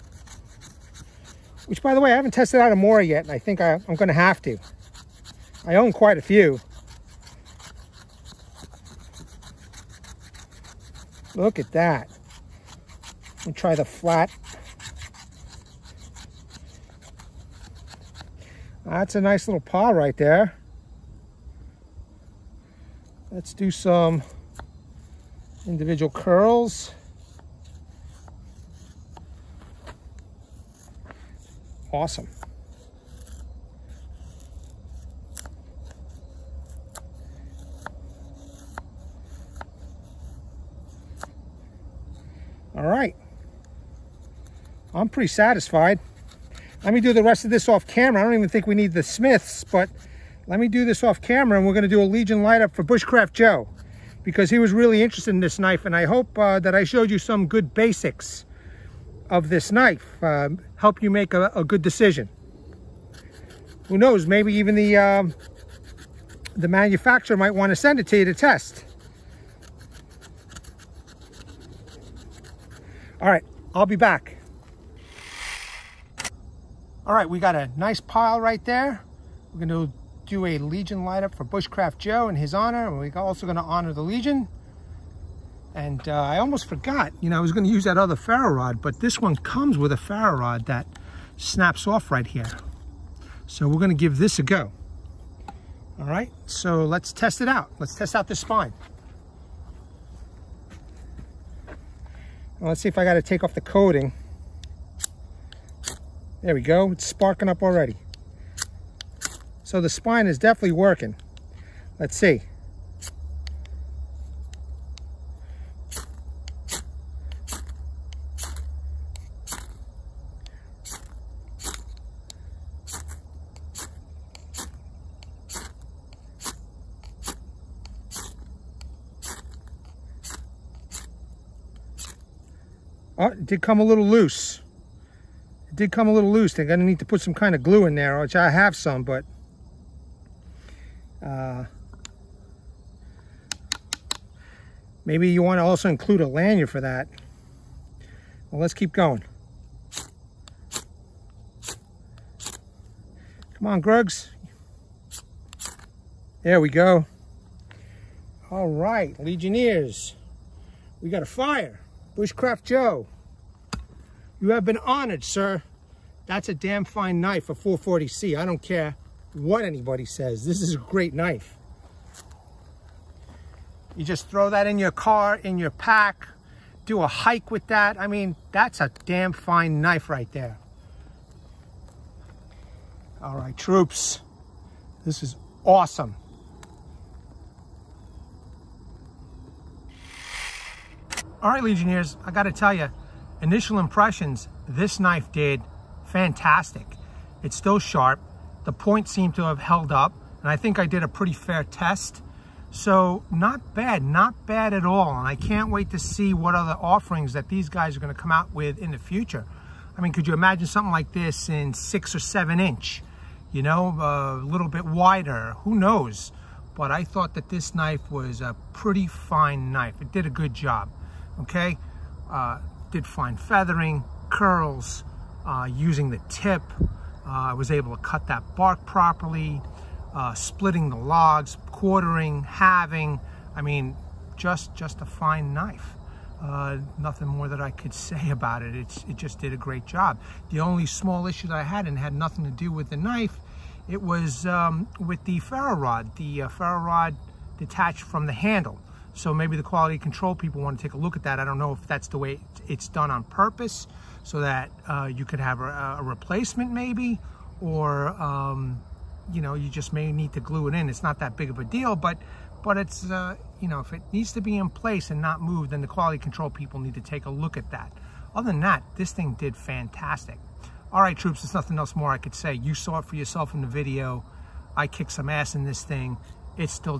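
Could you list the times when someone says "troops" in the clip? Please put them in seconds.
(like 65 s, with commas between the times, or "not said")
183 s, 271 s.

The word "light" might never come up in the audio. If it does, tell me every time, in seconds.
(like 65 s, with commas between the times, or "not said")
52 s, 81 s.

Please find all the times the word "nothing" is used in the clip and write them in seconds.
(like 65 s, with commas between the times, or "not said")
236 s, 242 s, 271 s.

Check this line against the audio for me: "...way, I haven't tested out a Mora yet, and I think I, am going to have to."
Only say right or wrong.
right.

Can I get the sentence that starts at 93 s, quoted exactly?
So we're gonna give this a go.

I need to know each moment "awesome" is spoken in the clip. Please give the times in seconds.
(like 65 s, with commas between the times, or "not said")
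31 s, 185 s.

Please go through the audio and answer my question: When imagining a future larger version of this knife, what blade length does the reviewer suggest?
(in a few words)
6 or 7 inch.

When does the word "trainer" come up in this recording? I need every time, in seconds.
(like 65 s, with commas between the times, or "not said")
not said.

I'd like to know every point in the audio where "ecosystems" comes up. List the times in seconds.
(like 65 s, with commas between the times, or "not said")
not said.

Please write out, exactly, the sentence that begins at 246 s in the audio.
The uh, ferro rod detached from the handle.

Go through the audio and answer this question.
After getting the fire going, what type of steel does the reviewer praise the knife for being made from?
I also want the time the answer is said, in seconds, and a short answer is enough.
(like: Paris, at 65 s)
440C, at 167 s.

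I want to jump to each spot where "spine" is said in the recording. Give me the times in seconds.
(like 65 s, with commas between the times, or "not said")
98 s, 109 s.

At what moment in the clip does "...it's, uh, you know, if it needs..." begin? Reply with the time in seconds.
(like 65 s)
262 s.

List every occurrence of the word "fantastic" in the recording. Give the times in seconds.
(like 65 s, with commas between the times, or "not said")
196 s, 269 s.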